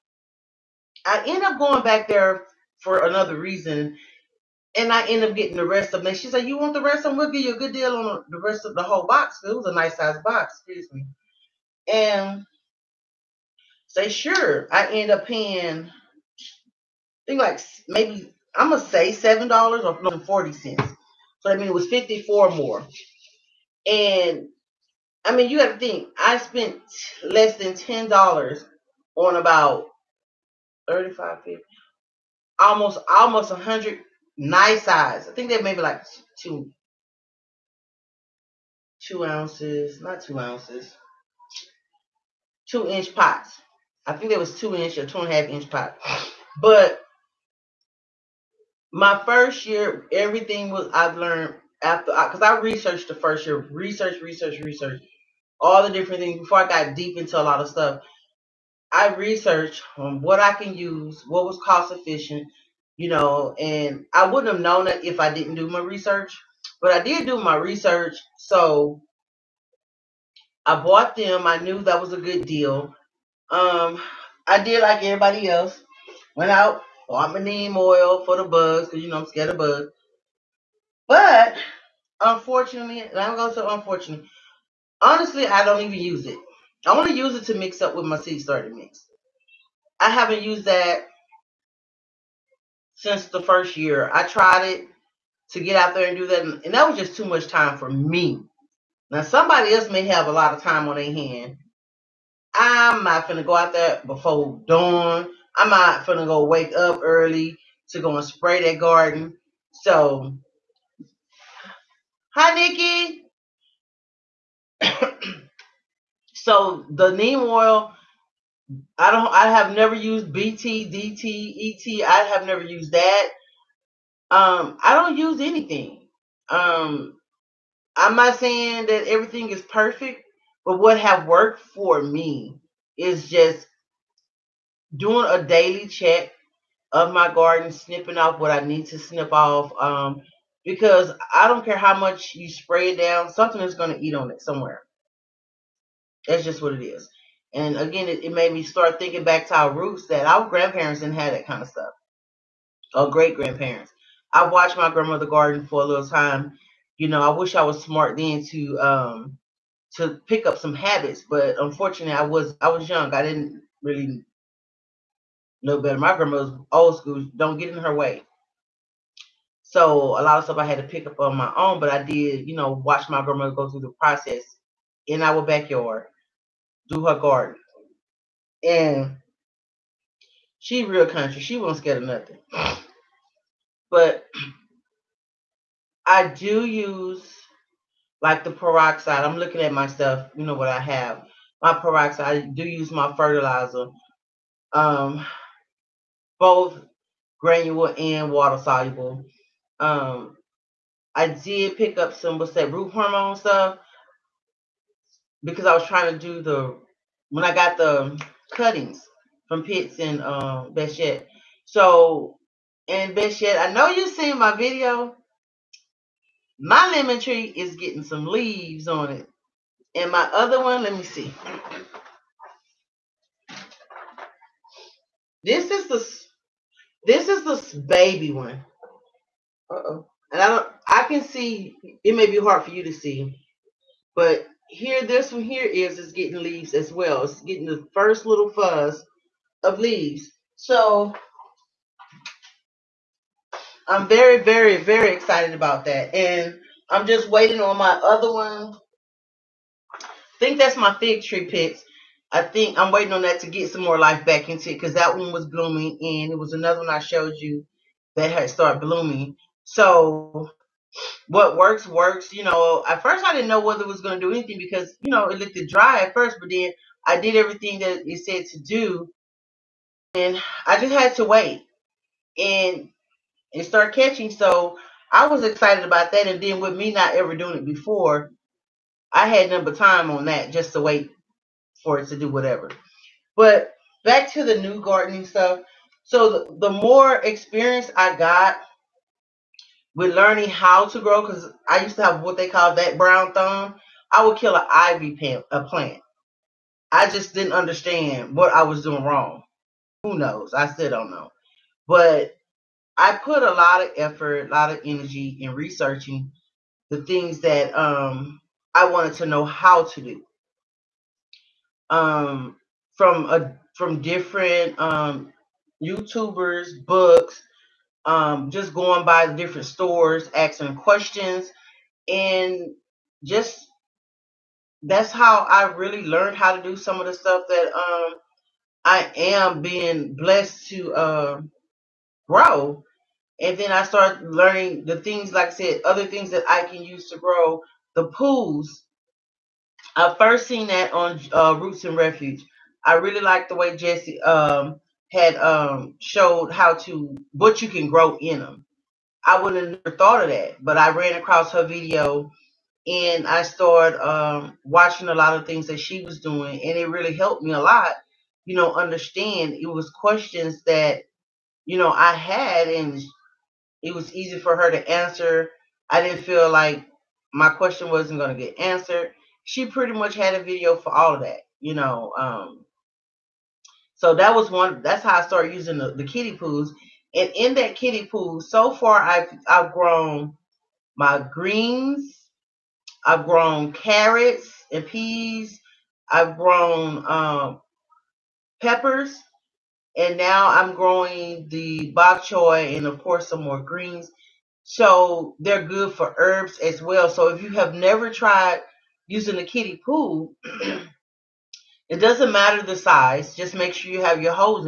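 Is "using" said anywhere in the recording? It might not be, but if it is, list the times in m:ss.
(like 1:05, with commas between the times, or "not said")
6:15, 6:39.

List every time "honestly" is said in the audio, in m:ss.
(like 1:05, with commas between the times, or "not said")
1:24.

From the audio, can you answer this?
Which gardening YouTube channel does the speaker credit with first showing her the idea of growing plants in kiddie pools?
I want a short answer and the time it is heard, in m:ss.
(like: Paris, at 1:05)
Roots and Refuge, at 5:41.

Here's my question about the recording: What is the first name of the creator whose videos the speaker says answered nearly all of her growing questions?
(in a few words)
Jesse.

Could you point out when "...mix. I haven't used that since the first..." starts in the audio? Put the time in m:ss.
1:28.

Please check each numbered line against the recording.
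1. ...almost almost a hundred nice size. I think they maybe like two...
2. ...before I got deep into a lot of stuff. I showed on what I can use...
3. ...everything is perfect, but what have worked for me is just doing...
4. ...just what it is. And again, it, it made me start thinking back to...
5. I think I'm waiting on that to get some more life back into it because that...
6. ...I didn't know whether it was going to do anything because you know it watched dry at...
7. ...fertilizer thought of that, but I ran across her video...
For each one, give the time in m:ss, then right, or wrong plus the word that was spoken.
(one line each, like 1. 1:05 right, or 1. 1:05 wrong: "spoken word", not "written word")
1. 0:32 right
2. 0:56 wrong: "researched", not "showed"
3. 2:09 right
4. 2:26 right
5. 4:12 right
6. 4:23 wrong: "looked", not "watched"
7. 5:49 wrong: "never", not "fertilizer".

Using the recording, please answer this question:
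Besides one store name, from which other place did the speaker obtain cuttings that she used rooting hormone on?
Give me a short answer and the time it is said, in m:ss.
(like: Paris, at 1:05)
Pitts, at 3:29.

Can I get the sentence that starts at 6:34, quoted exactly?
So they're good for herbs as well.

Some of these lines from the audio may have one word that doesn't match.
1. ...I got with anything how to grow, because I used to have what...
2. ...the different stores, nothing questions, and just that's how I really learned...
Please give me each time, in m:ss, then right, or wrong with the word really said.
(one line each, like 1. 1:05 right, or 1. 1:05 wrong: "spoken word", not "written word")
1. 4:47 wrong: "learning", not "anything"
2. 5:19 wrong: "asking", not "nothing".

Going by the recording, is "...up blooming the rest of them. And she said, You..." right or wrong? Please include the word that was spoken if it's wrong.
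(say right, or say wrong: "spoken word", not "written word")
wrong: "getting", not "blooming".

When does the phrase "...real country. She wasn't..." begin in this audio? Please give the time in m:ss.
3:00.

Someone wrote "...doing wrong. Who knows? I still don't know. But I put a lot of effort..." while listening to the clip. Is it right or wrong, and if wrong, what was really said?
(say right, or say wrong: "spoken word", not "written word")
right.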